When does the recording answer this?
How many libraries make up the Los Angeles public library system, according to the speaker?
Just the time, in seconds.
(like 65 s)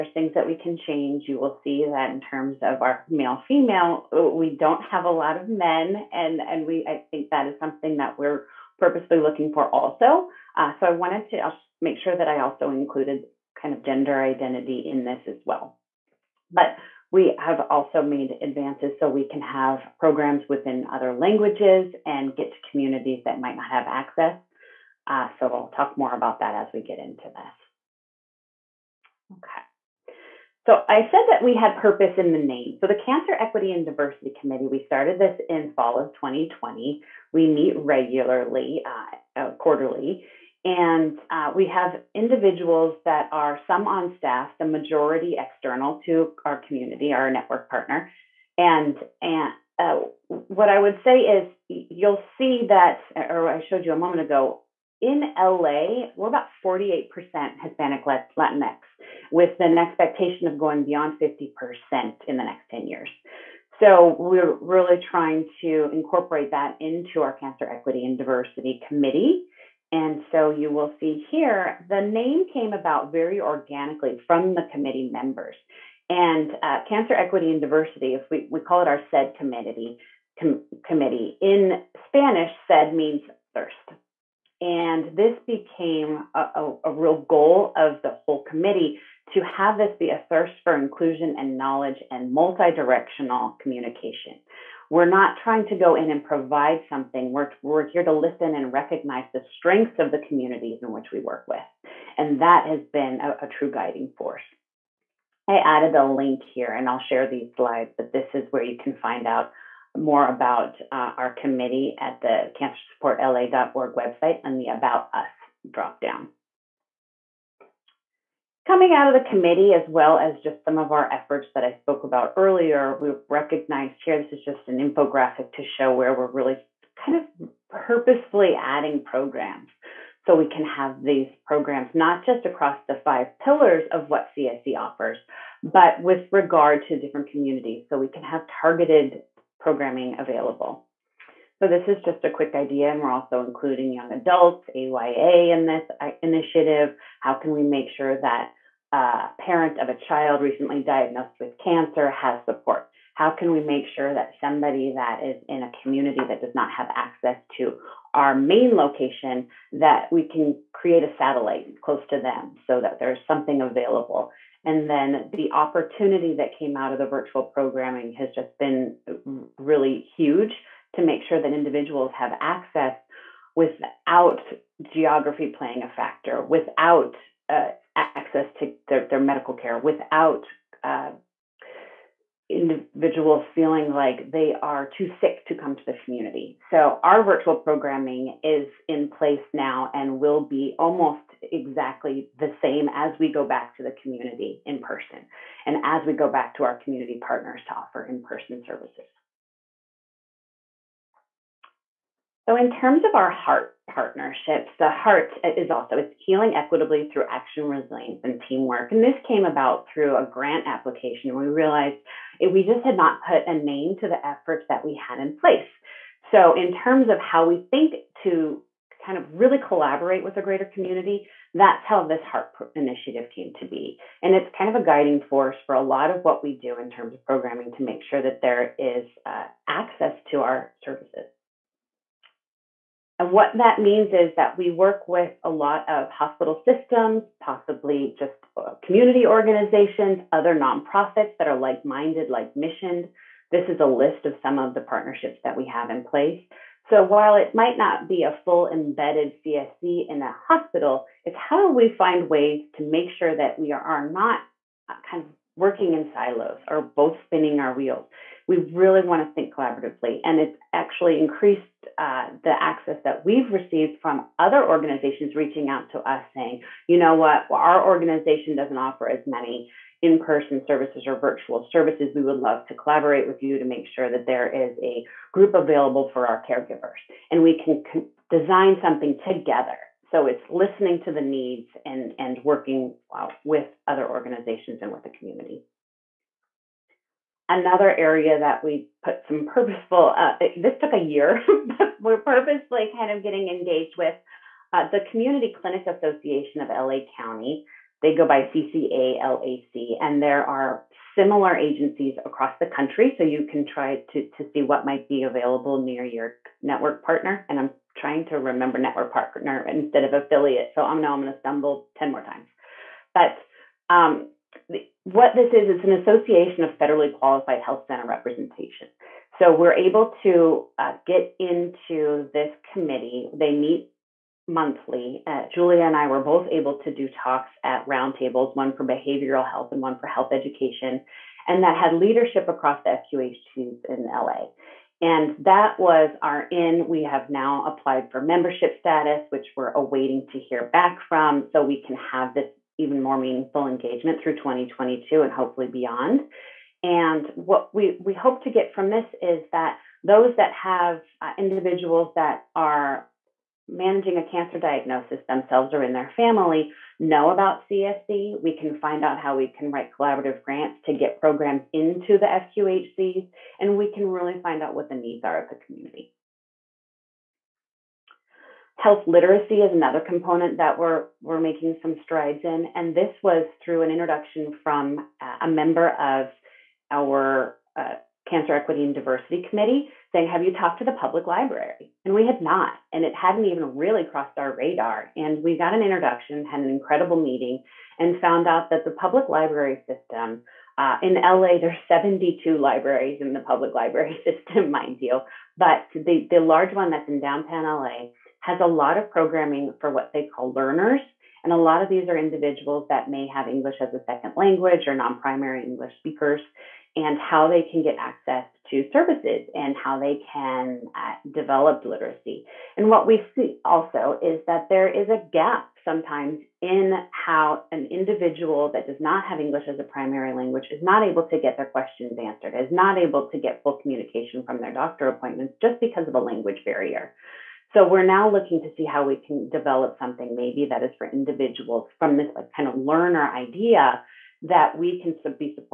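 391 s.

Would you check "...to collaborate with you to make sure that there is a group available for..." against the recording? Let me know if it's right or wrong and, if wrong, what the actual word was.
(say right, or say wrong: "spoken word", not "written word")
right.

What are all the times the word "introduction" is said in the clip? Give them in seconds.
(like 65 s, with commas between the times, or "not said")
373 s, 385 s.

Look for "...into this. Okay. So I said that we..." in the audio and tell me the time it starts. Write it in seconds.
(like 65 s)
26 s.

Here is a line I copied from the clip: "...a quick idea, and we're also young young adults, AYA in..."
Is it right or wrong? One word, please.
wrong.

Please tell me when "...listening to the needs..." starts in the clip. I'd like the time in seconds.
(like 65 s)
280 s.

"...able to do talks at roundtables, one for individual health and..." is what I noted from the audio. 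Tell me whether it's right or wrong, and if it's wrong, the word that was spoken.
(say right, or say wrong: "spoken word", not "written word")
wrong: "behavioral", not "individual".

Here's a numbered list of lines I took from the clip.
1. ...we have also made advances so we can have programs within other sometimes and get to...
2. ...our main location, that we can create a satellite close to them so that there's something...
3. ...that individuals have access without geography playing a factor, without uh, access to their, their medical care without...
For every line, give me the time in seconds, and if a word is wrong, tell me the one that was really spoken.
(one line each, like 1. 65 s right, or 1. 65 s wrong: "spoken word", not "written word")
1. 17 s wrong: "languages", not "sometimes"
2. 158 s right
3. 171 s right.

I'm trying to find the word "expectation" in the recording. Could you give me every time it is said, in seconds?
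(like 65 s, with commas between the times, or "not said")
59 s.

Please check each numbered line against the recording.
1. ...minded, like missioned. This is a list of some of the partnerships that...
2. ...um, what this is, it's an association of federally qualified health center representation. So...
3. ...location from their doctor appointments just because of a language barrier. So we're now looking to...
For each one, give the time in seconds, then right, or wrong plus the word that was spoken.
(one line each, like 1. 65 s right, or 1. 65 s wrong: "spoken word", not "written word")
1. 241 s right
2. 313 s right
3. 423 s wrong: "communication", not "location".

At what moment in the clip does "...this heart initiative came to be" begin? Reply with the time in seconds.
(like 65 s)
222 s.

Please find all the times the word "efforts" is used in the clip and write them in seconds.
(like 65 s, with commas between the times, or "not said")
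121 s, 214 s.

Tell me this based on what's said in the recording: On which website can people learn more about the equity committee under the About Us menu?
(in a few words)
cancersupportla.org.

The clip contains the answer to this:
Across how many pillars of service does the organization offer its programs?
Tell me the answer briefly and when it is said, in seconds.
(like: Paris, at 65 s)
5, at 133 s.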